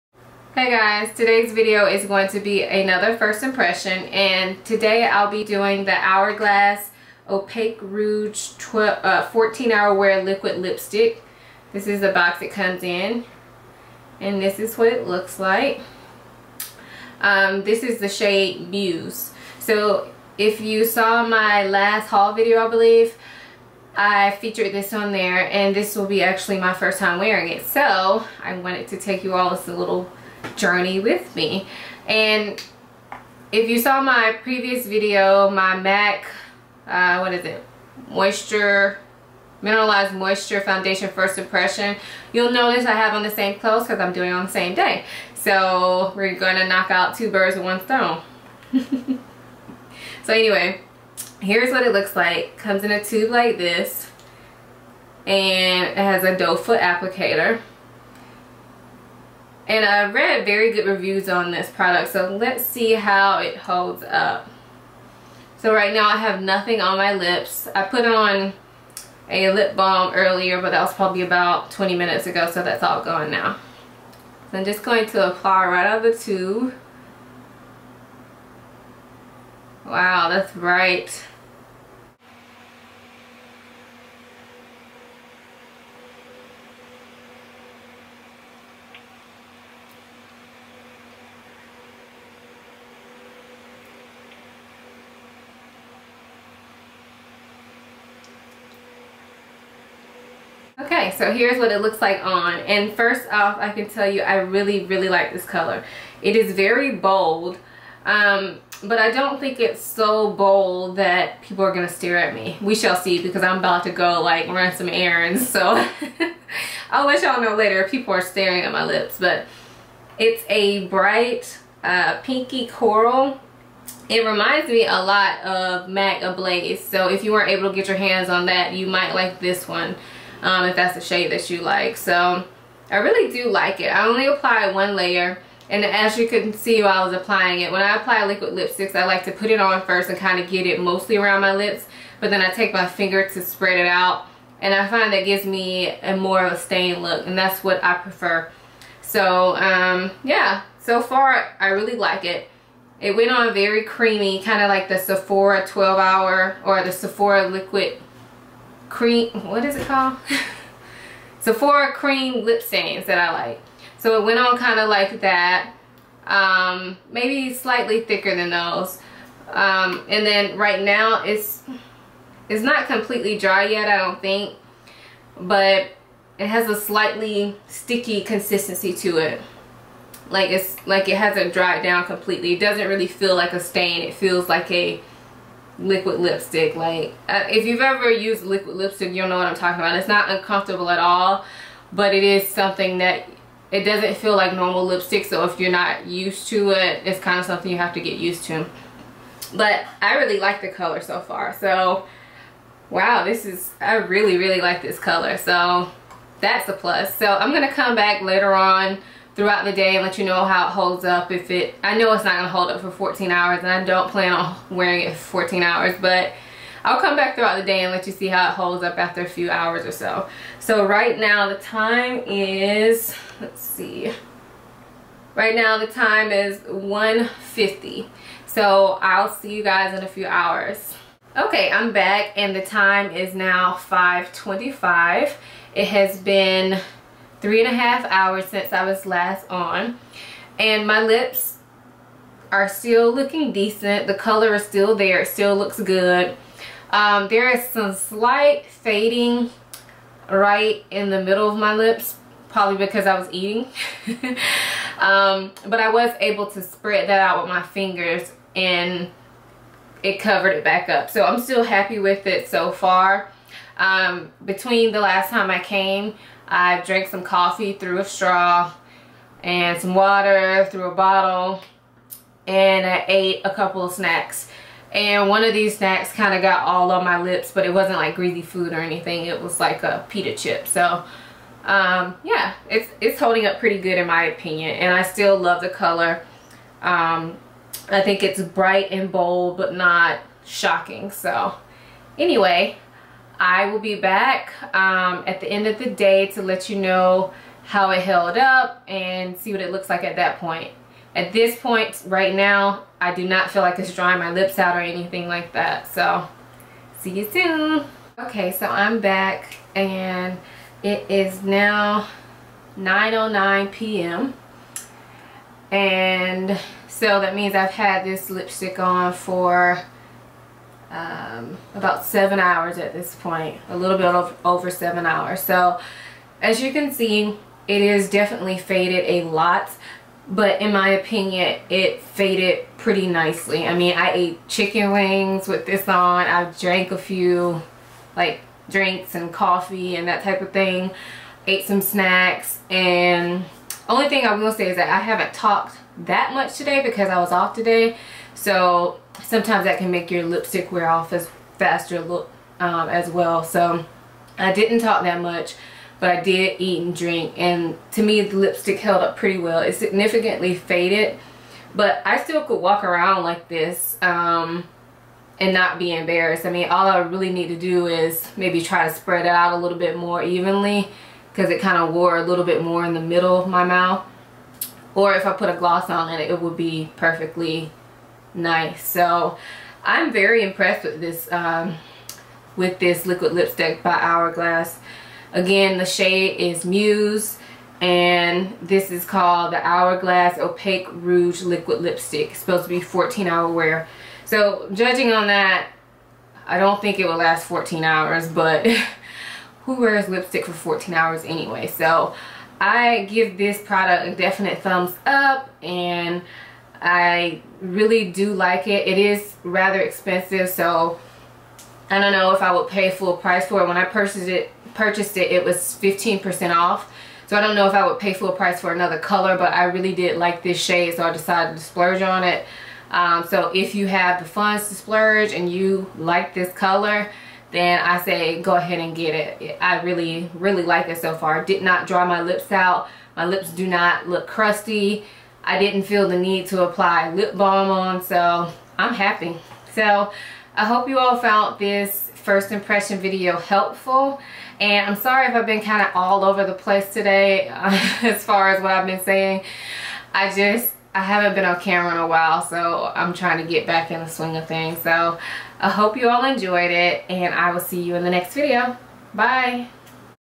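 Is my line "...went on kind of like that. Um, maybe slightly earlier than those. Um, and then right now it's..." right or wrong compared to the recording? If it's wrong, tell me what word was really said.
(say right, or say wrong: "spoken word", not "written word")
wrong: "thicker", not "earlier".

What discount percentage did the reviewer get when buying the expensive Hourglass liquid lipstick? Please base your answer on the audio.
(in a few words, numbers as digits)
15%.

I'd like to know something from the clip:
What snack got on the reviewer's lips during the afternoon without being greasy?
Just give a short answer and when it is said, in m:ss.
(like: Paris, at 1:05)
Pita chip, at 4:40.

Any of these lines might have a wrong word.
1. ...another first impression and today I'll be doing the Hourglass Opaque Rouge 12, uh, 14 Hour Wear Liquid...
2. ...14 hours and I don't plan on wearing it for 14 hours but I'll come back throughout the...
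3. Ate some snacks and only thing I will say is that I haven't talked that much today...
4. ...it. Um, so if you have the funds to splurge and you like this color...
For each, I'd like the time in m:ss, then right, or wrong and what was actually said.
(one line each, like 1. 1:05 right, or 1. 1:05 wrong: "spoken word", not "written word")
1. 0:02 right
2. 3:32 right
3. 5:41 right
4. 7:02 right.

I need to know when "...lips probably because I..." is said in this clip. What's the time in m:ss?
4:11.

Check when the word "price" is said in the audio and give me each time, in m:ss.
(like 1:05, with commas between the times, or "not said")
6:53, 6:58.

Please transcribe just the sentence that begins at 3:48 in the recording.
so I'll see you guys in a few hours okay I'm back and the time is now 5:25.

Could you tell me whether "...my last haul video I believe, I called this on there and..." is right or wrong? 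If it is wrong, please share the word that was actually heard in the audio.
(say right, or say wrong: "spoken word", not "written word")
wrong: "featured", not "called".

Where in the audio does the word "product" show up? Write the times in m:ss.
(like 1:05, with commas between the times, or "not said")
1:01, 6:43.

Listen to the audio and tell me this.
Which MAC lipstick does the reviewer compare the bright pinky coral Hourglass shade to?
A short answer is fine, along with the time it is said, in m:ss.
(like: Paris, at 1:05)
MAC Ablaze, at 2:05.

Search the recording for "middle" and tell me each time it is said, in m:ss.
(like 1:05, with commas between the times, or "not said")
4:11, 6:13.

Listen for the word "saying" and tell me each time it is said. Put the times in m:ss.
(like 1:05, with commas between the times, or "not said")
7:29.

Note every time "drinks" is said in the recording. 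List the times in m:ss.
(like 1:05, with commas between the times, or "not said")
5:38, 5:56.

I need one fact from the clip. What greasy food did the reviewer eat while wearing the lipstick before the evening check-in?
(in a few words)
Chicken wings.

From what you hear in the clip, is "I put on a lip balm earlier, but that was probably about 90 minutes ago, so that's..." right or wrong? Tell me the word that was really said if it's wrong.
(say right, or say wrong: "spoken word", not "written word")
wrong: "20", not "90".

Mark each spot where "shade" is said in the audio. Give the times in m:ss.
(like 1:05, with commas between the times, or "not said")
0:18, 2:11, 6:25, 7:00.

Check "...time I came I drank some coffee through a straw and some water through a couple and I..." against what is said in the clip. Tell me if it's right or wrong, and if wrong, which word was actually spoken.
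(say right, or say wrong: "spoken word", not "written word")
wrong: "bottle", not "couple".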